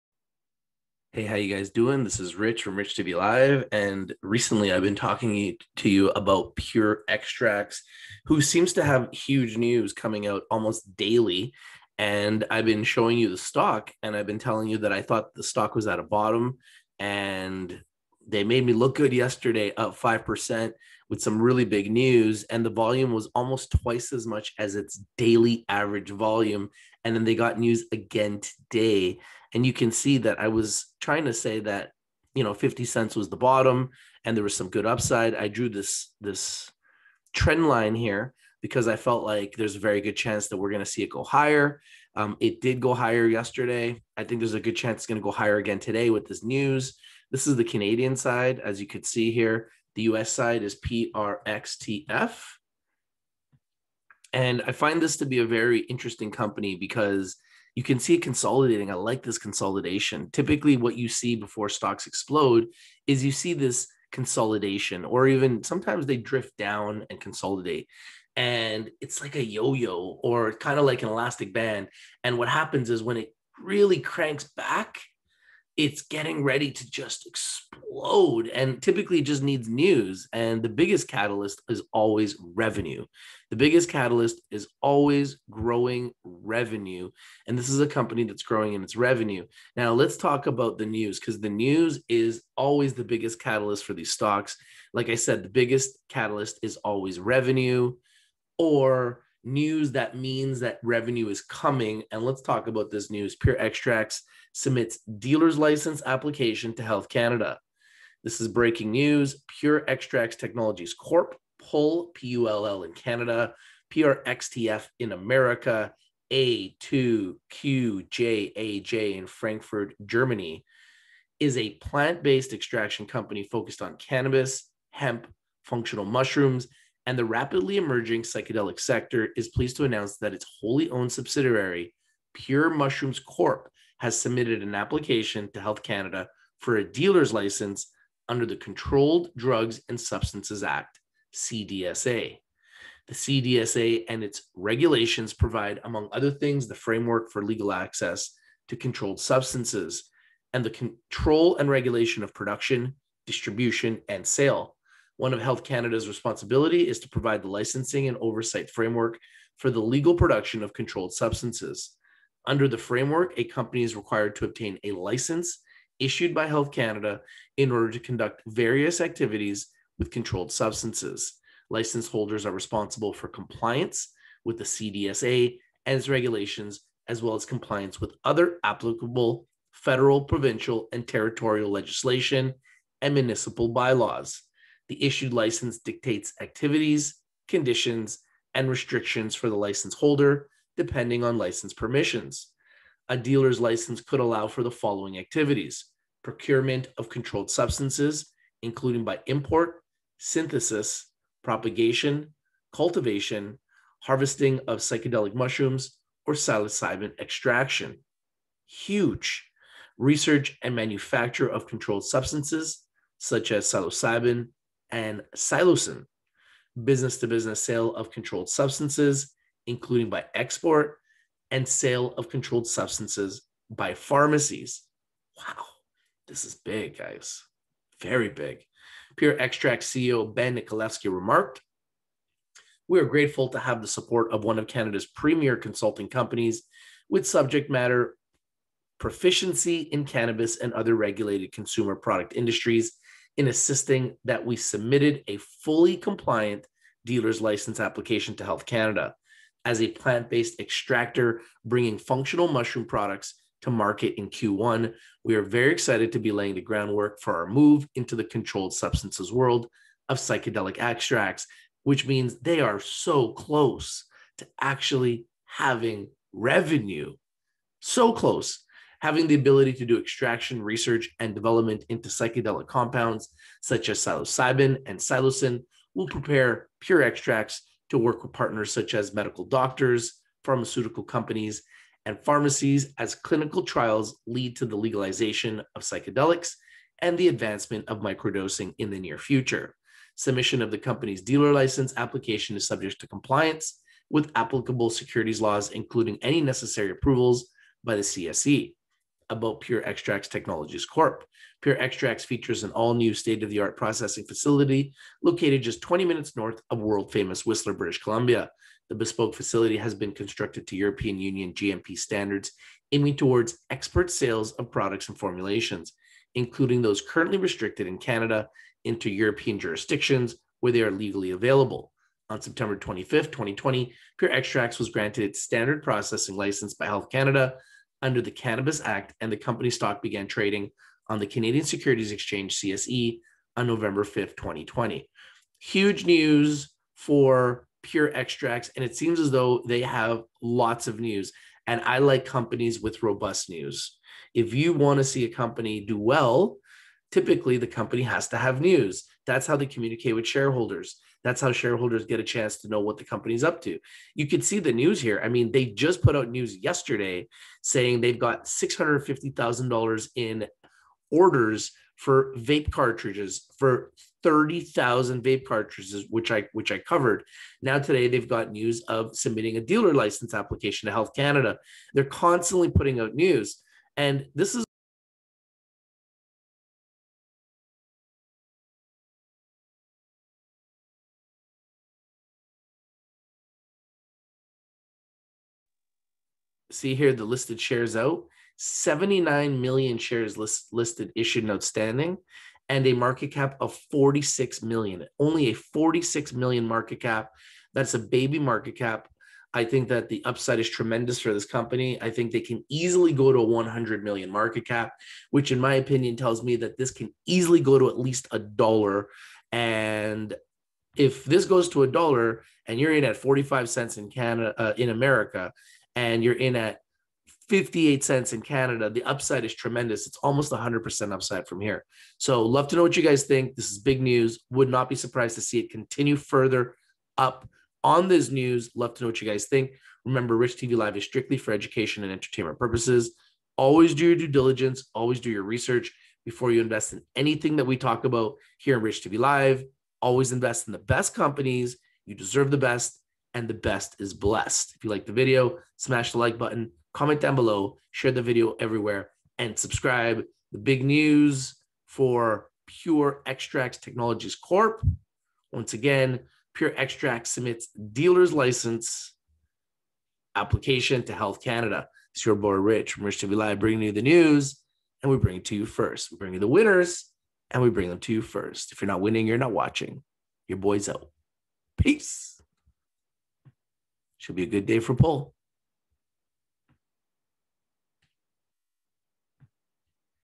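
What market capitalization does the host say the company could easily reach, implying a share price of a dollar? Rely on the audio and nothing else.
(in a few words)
100 million.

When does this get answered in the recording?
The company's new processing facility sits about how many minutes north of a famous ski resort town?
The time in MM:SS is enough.
05:05.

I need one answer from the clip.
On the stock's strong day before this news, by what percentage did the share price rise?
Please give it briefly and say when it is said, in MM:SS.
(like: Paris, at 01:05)
5%, at 00:19.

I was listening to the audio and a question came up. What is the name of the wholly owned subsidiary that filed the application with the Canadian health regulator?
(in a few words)
Pure Mushrooms Corp.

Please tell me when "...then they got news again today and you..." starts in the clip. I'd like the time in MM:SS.
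00:27.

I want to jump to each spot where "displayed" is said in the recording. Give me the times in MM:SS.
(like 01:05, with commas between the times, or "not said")
not said.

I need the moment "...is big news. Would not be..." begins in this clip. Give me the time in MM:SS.
07:03.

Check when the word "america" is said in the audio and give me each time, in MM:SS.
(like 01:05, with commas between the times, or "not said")
01:55, 06:54.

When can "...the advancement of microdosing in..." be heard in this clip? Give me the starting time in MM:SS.
04:47.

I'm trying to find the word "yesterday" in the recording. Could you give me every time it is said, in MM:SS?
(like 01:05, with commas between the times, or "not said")
00:19, 00:43, 05:56.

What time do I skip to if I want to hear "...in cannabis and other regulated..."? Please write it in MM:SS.
03:59.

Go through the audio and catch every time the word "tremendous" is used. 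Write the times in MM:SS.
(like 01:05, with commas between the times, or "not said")
06:40, 06:59.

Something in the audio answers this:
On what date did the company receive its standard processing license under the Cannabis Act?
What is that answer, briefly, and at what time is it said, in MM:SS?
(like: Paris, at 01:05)
September 25, 2020, at 05:22.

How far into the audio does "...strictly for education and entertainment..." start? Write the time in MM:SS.
07:11.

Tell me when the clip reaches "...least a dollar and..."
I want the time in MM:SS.
06:47.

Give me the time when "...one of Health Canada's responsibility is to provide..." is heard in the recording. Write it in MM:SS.
02:35.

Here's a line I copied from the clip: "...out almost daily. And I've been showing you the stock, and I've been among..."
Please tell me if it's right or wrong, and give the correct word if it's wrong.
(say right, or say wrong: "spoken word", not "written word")
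wrong: "telling", not "among".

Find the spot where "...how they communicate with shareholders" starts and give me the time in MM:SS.
05:49.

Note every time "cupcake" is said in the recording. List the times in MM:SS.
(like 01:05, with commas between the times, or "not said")
not said.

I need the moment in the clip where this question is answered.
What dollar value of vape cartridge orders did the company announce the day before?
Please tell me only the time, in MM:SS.
05:58.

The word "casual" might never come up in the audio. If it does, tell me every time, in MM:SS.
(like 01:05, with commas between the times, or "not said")
not said.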